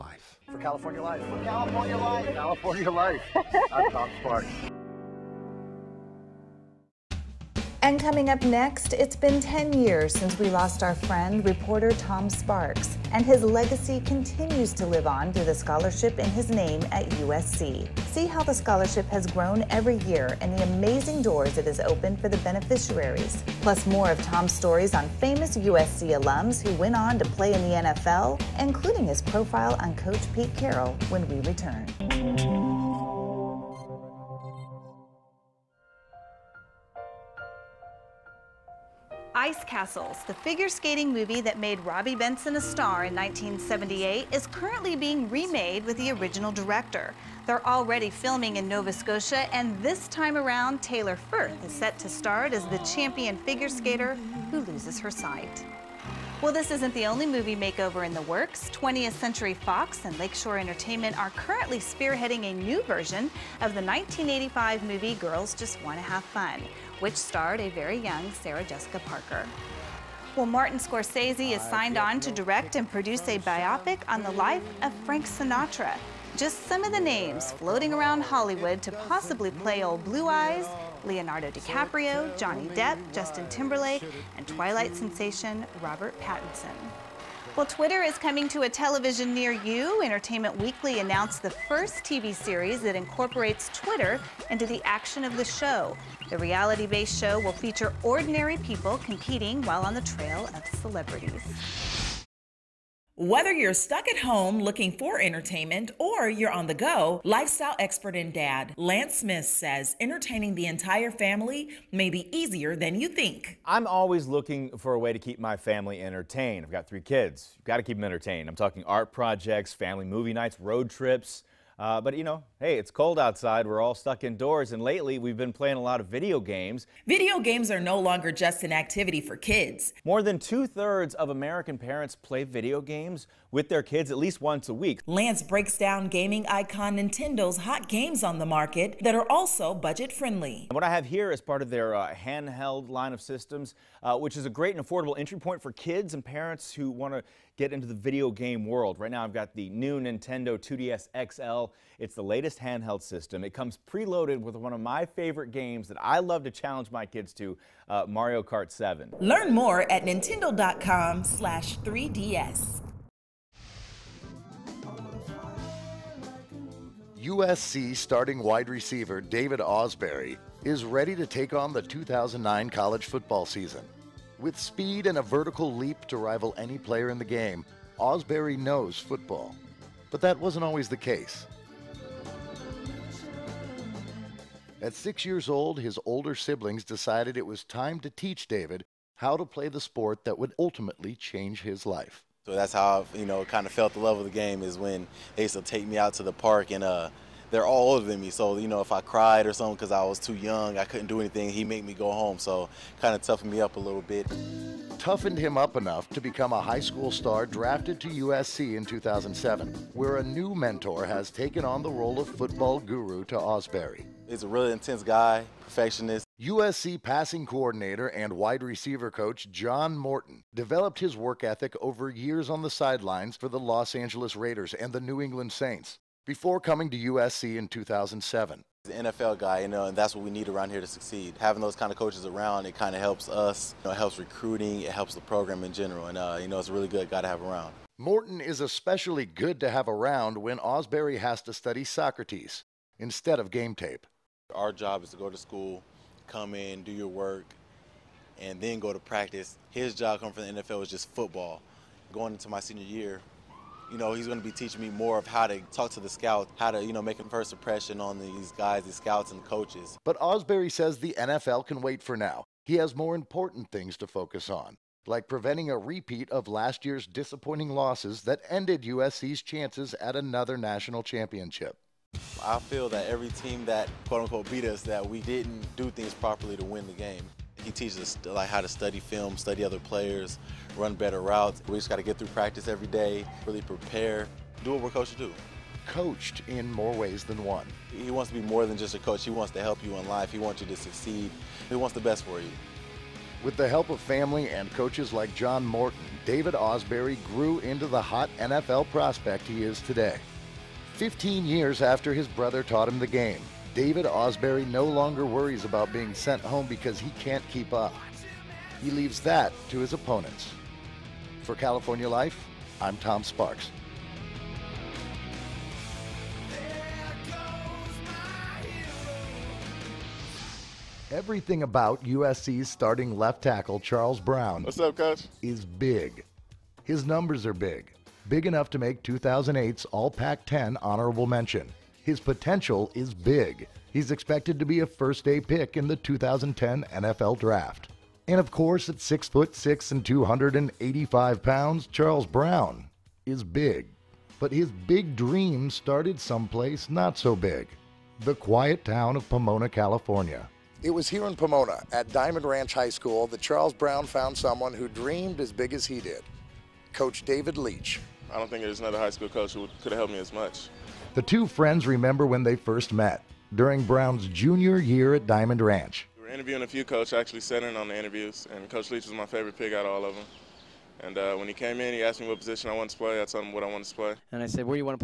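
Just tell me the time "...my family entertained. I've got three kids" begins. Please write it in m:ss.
1:55.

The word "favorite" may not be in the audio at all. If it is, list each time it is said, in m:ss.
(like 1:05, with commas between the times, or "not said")
2:35, 6:09.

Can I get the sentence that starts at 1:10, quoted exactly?
Well, Martin Scorsese is signed on to direct and produce a biopic on the life of Frank Sinatra.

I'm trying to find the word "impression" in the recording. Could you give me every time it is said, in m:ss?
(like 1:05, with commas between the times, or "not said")
4:17.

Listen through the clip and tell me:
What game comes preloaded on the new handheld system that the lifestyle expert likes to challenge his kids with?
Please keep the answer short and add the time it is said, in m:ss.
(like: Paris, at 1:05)
Mario Kart 7, at 2:38.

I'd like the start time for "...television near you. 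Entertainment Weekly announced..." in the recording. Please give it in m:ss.
1:28.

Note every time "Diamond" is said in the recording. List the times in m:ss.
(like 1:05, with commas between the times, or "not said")
5:52, 6:05.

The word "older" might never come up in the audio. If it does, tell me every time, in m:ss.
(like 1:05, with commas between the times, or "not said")
3:06, 3:17.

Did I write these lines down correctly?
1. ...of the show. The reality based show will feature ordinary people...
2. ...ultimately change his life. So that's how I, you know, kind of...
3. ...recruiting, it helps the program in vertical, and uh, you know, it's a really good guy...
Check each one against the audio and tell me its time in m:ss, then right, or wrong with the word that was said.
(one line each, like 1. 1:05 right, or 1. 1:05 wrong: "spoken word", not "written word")
1. 1:35 right
2. 3:10 right
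3. 3:54 wrong: "general", not "vertical".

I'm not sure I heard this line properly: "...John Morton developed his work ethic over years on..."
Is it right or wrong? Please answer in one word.
right.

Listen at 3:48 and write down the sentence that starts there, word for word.
He's an NFL guy, you know, and that's what we need around here to succeed.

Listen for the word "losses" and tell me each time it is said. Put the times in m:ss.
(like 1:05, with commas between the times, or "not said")
4:27.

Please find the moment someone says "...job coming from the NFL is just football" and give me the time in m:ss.
4:09.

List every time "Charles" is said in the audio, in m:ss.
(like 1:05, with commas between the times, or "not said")
5:23, 5:41, 5:53.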